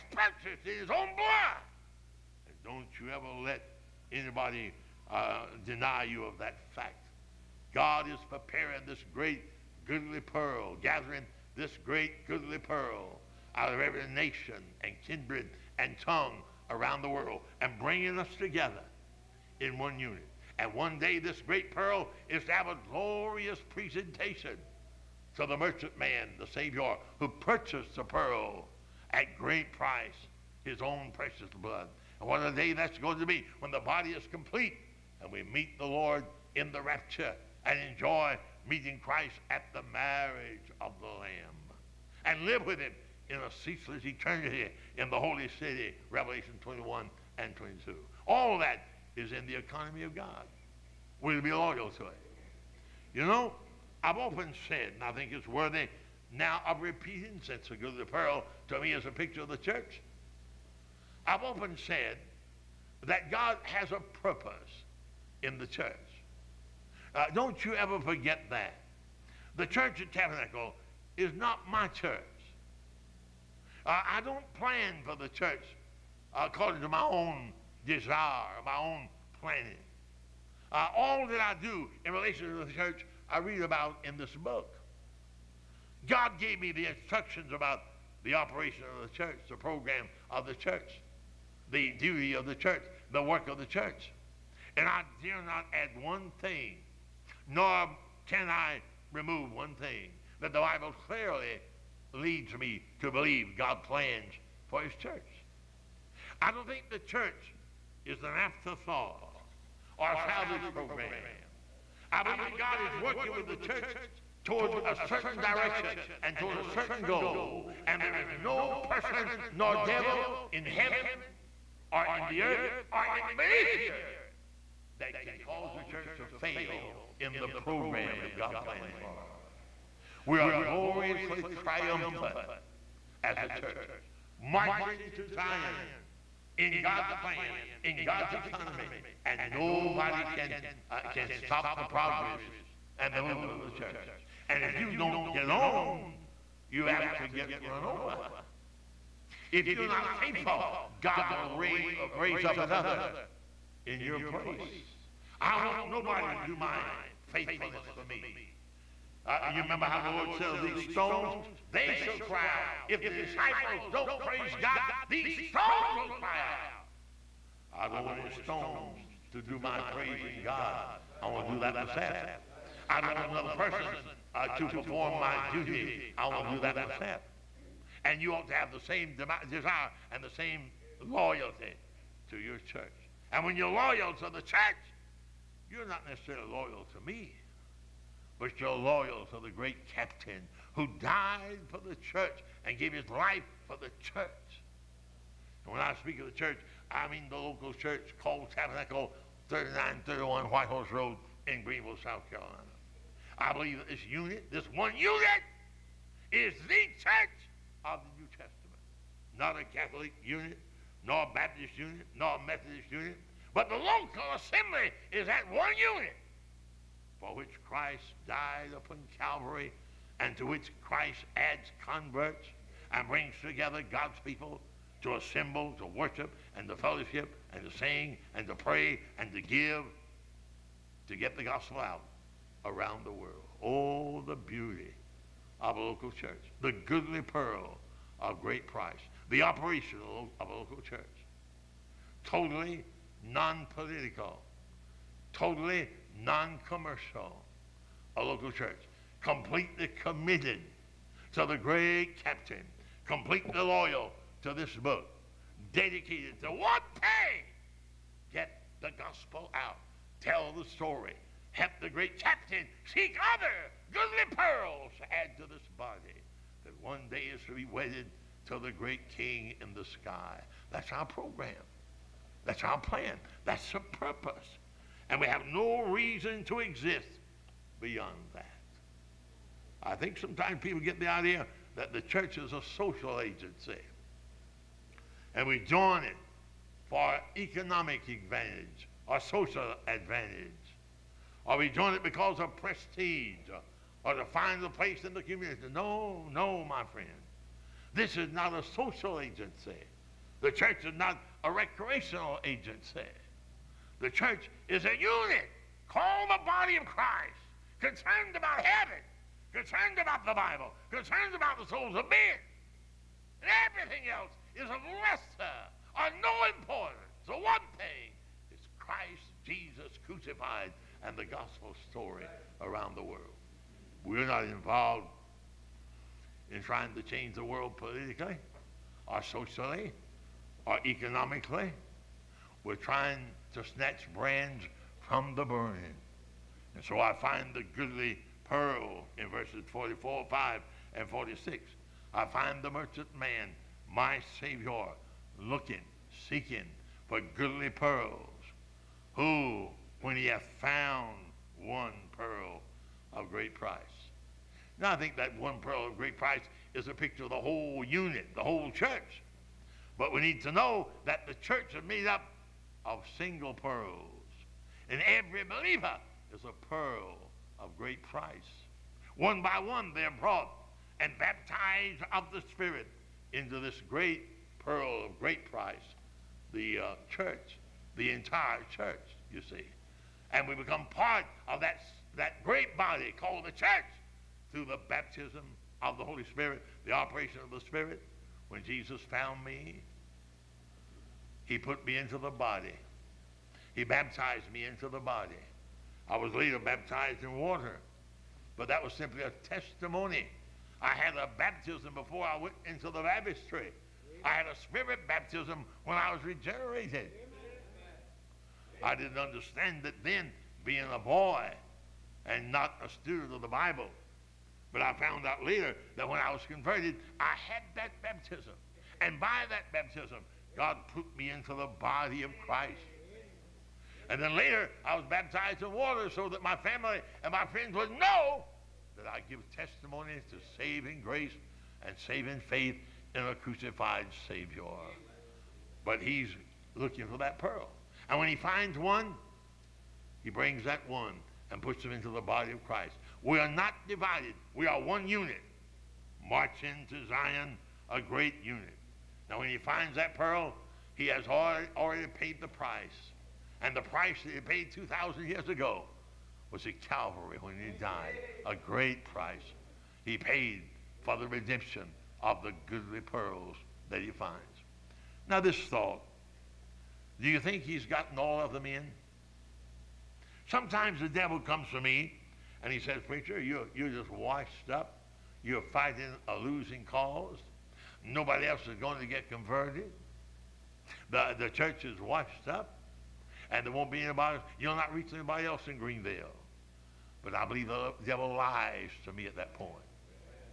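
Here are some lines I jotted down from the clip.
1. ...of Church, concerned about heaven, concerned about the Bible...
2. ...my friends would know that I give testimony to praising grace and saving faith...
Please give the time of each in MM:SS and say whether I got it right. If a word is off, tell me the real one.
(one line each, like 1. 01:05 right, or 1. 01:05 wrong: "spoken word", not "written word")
1. 05:06 wrong: "Christ", not "Church"
2. 07:07 wrong: "saving", not "praising".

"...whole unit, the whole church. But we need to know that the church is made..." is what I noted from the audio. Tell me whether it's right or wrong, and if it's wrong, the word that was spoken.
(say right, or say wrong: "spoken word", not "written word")
right.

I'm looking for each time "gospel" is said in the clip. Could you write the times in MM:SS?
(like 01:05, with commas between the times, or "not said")
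03:51, 04:18, 05:21.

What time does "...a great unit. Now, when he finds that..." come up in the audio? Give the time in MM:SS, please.
07:27.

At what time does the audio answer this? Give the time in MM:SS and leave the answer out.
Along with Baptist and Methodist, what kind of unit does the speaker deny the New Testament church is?
03:29.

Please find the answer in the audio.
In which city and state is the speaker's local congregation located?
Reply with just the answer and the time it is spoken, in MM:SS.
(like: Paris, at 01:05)
Greenville, South Carolina, at 03:21.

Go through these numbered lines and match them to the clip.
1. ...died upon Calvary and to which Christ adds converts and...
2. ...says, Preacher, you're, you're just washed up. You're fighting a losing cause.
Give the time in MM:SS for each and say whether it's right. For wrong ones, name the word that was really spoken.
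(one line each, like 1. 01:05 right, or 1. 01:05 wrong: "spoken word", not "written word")
1. 03:38 right
2. 07:52 right.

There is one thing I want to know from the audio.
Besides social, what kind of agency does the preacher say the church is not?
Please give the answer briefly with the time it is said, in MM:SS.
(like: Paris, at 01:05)
recreational, at 05:01.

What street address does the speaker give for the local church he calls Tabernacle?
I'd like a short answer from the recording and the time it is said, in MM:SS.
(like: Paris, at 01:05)
3931 White Horse Road, at 03:19.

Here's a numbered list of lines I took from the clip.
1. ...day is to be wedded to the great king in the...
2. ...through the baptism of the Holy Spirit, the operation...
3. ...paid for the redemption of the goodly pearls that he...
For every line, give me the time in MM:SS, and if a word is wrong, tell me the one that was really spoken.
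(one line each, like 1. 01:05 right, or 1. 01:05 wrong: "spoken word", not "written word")
1. 04:27 right
2. 06:24 right
3. 07:40 right.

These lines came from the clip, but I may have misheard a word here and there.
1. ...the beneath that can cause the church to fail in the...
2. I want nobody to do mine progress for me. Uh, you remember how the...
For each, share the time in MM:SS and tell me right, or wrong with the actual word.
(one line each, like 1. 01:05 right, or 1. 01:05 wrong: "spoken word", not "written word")
1. 02:03 wrong: "earth", not "beneath"
2. 02:35 wrong: "faithfulness", not "progress".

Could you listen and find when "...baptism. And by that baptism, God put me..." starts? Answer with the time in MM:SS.
06:58.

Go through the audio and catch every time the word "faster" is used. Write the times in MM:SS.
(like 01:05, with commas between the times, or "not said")
not said.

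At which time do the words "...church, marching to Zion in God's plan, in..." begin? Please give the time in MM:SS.
02:13.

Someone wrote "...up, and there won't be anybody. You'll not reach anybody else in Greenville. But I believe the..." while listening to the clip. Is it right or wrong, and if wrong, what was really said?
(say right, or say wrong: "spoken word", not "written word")
right.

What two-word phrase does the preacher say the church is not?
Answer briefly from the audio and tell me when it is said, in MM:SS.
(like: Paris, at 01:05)
salvage program, at 01:50.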